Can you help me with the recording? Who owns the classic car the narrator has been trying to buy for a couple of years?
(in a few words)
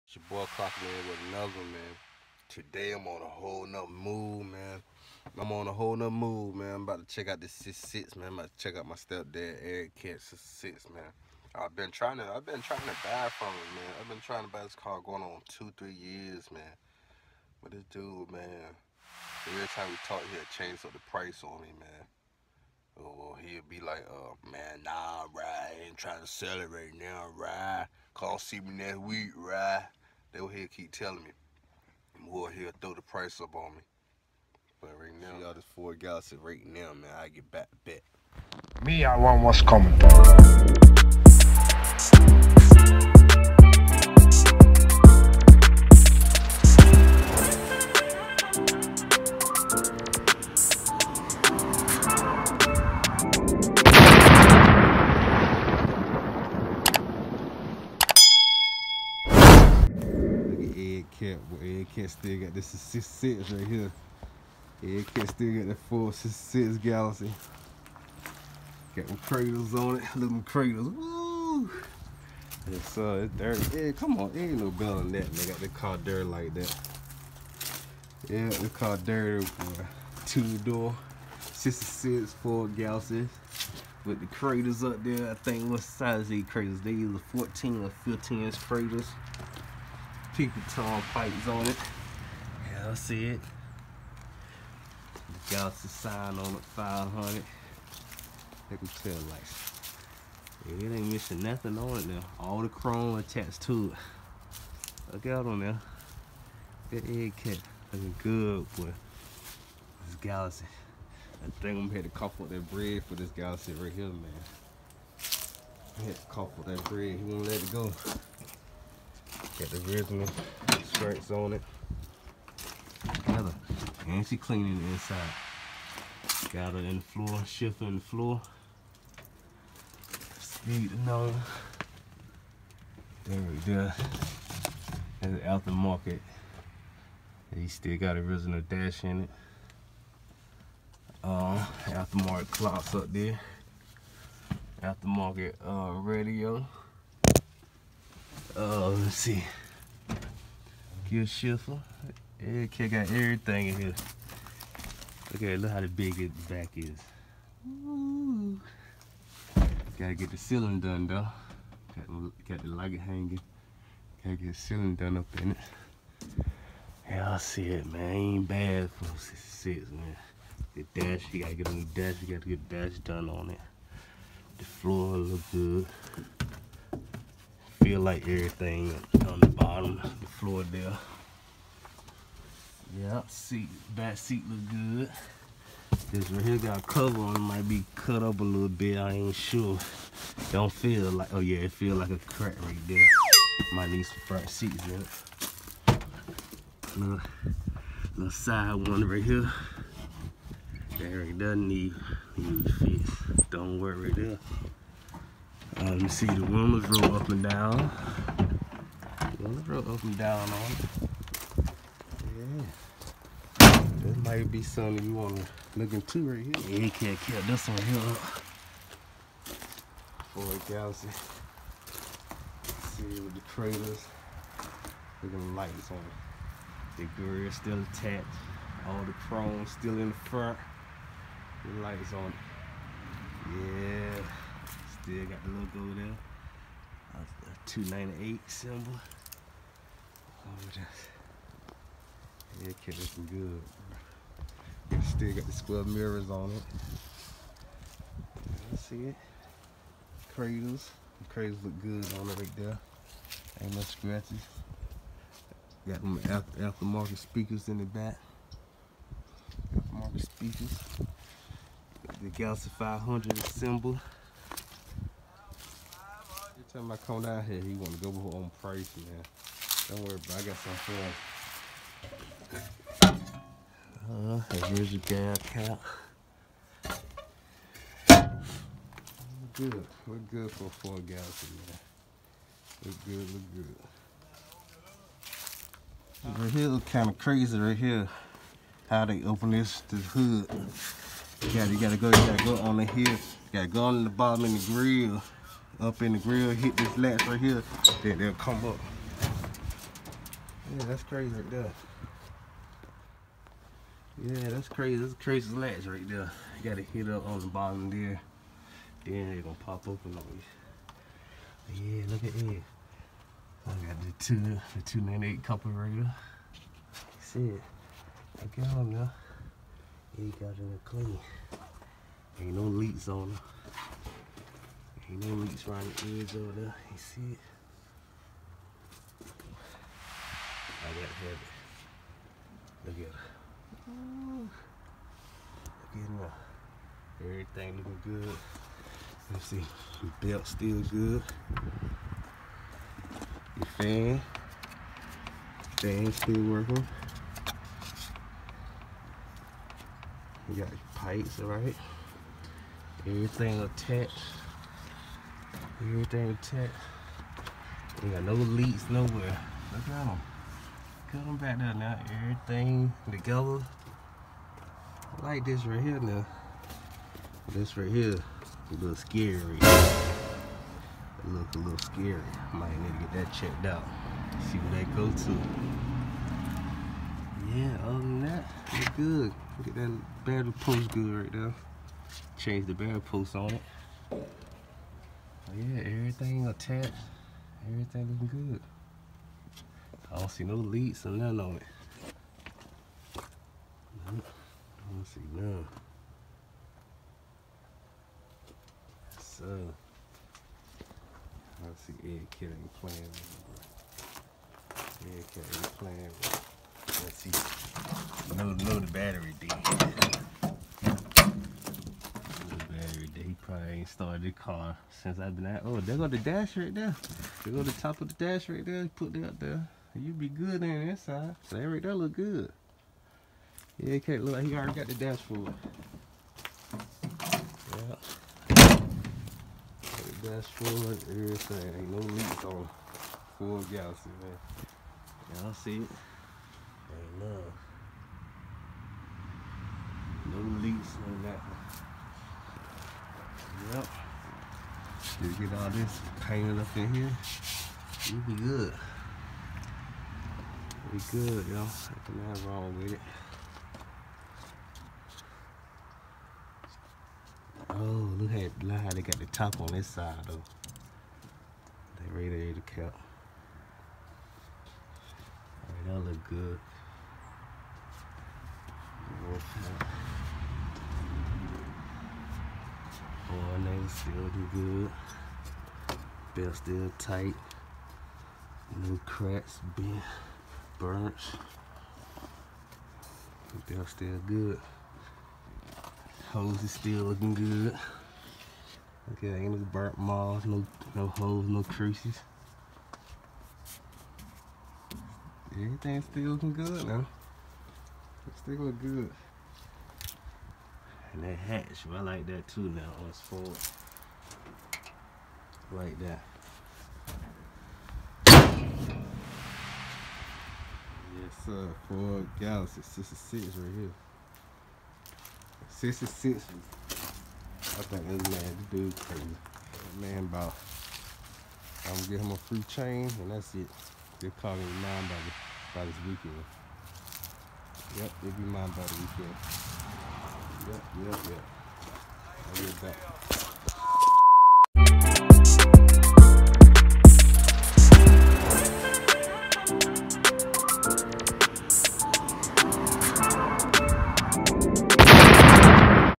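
stepdad Eric.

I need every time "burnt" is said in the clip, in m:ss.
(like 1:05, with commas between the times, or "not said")
8:00, 8:09.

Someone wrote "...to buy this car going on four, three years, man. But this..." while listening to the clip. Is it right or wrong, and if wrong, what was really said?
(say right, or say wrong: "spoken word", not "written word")
wrong: "two", not "four".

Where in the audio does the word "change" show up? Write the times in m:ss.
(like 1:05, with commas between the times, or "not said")
0:20, 6:22.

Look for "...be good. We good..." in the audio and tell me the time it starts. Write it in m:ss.
7:28.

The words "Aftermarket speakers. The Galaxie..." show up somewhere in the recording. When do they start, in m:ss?
4:19.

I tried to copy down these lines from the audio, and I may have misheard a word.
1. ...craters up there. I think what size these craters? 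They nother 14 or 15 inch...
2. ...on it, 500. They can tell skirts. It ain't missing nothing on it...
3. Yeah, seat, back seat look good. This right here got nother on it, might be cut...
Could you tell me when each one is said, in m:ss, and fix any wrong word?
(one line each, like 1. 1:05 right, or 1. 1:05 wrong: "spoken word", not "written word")
1. 1:24 wrong: "either", not "nother"
2. 1:36 wrong: "lights", not "skirts"
3. 3:02 wrong: "cover", not "nother".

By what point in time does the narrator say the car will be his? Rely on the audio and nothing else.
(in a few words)
the weekend.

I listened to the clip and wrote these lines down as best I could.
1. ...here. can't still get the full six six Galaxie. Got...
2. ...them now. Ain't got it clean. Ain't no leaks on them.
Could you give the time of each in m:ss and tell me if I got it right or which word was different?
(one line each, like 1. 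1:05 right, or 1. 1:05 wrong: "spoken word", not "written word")
1. 1:03 right
2. 5:18 right.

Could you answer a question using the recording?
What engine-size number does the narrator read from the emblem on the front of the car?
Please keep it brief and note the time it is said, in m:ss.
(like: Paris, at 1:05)
298, at 3:57.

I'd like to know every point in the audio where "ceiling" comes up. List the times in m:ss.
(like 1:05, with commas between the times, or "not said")
2:40, 2:44.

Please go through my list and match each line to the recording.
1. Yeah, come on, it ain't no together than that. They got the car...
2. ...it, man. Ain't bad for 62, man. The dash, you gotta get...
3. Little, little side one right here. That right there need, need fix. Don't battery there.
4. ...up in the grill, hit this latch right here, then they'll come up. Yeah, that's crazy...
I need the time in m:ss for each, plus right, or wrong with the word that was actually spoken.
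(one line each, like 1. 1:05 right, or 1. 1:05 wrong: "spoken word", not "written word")
1. 1:13 wrong: "better", not "together"
2. 2:47 wrong: "66", not "62"
3. 3:16 wrong: "worry", not "battery"
4. 4:55 right.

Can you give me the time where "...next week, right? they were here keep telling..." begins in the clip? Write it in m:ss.
0:28.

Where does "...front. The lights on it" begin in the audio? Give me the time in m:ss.
3:50.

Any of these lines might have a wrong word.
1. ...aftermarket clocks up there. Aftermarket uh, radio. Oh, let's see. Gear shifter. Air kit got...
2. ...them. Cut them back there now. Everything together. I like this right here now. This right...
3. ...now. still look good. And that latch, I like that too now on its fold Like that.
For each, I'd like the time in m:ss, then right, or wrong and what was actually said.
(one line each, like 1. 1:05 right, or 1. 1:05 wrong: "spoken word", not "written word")
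1. 2:21 right
2. 5:59 right
3. 8:16 wrong: "hatch", not "latch".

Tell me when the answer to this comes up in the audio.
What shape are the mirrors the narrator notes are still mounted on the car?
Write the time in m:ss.
4:05.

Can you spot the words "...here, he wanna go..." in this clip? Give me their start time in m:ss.
4:27.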